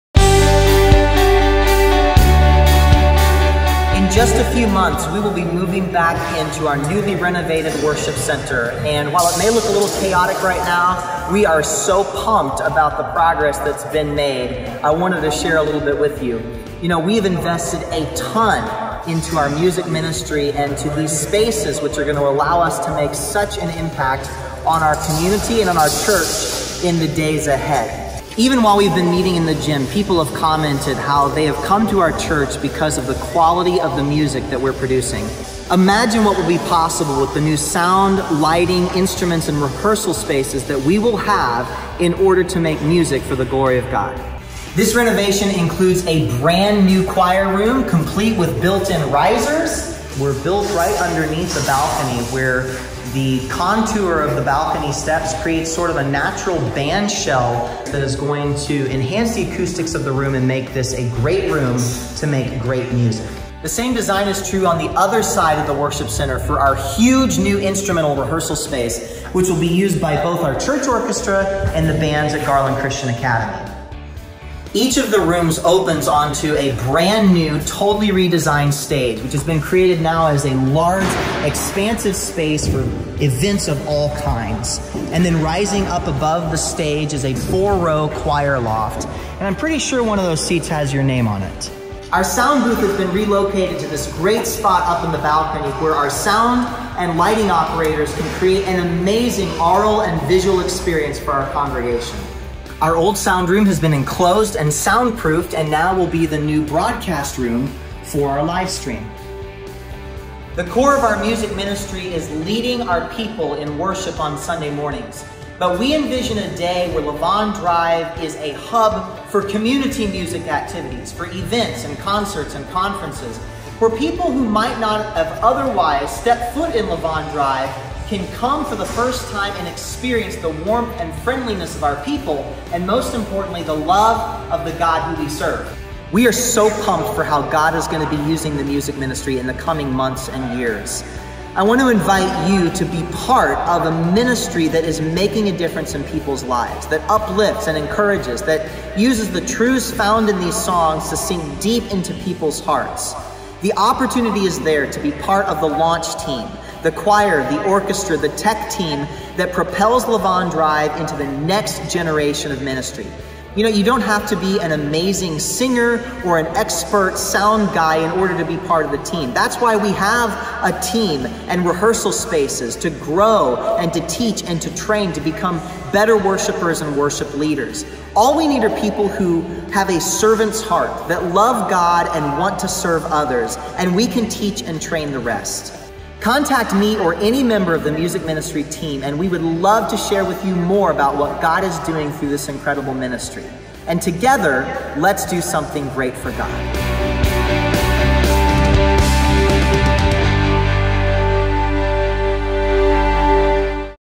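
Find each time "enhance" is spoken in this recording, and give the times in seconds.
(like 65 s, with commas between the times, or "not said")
58 s.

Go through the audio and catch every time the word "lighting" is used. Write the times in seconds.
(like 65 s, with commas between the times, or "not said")
38 s, 97 s.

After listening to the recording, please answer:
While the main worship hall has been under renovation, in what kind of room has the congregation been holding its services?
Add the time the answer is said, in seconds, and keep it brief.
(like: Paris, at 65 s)
gym, at 29 s.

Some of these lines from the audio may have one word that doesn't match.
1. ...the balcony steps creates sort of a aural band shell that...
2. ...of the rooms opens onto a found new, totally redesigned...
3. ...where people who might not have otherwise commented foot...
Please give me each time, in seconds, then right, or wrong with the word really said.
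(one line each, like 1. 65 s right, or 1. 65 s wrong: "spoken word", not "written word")
1. 54 s wrong: "natural", not "aural"
2. 74 s wrong: "brand", not "found"
3. 123 s wrong: "stepped", not "commented".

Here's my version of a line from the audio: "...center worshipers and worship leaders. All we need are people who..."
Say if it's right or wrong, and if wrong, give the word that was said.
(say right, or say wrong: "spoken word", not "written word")
wrong: "better", not "center".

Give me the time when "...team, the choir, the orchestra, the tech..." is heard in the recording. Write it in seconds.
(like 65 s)
156 s.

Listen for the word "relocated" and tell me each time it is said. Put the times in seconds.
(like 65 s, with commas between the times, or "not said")
93 s.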